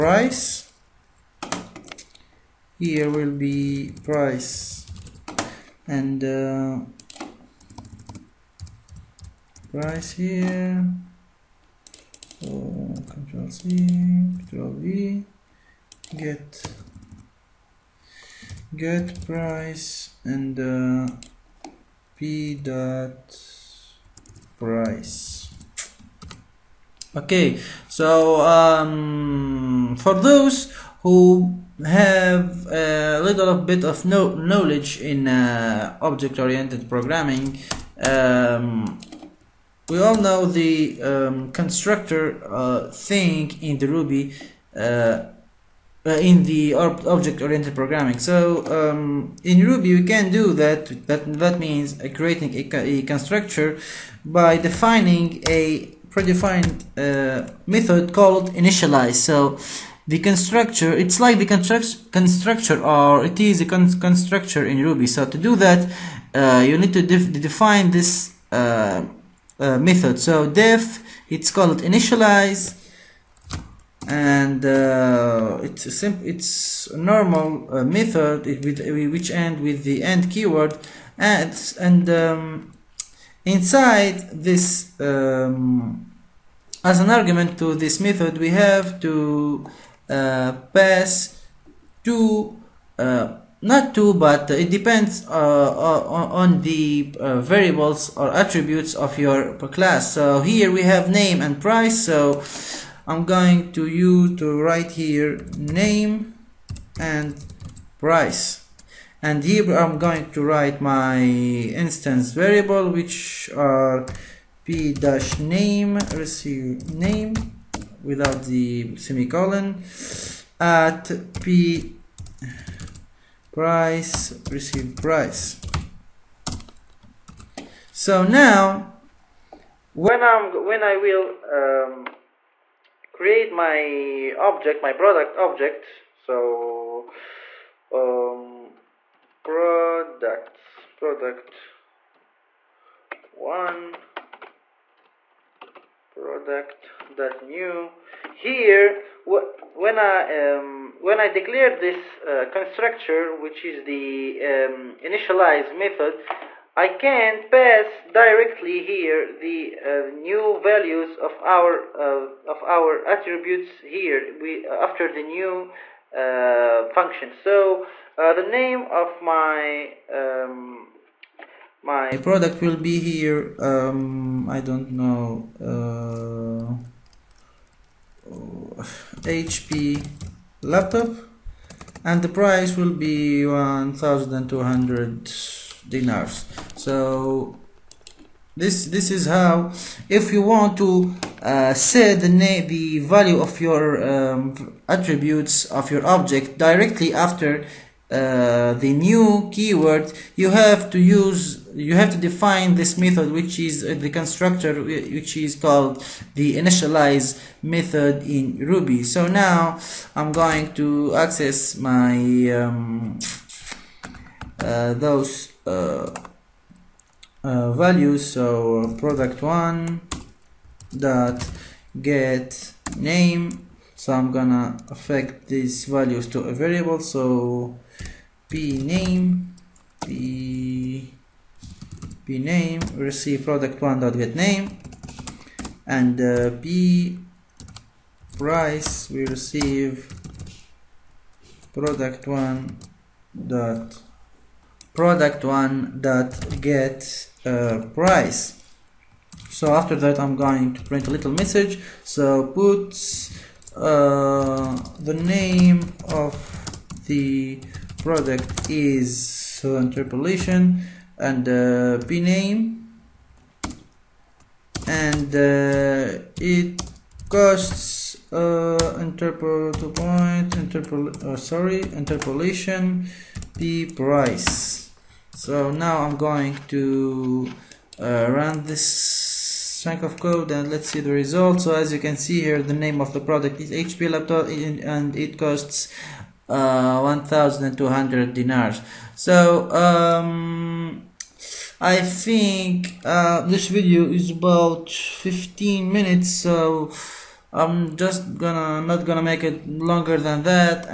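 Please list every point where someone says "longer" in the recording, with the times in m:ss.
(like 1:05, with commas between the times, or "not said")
4:59.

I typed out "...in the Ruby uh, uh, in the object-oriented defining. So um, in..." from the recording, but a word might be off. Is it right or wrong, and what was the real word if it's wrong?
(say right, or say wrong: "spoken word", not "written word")
wrong: "programming", not "defining".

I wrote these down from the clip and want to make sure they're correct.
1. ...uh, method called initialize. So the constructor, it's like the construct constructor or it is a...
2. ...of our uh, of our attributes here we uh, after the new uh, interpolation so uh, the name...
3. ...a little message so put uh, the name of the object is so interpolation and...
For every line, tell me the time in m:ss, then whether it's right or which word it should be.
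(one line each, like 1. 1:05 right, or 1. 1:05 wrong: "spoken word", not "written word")
1. 0:56 right
2. 2:41 wrong: "function", not "interpolation"
3. 4:11 wrong: "product", not "object".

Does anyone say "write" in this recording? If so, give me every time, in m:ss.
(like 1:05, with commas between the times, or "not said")
1:44, 1:50.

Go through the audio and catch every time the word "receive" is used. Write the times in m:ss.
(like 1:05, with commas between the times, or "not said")
1:56, 2:04, 3:52, 3:59.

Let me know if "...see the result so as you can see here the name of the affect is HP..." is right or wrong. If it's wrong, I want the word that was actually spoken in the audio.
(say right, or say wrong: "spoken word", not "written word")
wrong: "product", not "affect".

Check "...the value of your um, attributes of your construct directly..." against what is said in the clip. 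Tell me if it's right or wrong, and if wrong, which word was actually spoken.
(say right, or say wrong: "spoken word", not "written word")
wrong: "object", not "construct".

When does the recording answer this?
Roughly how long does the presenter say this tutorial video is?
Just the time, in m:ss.
4:54.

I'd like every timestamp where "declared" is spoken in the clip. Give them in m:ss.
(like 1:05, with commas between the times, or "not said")
2:31.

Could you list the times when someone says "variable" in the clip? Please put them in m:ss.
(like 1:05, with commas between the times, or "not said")
1:37, 1:52, 3:46.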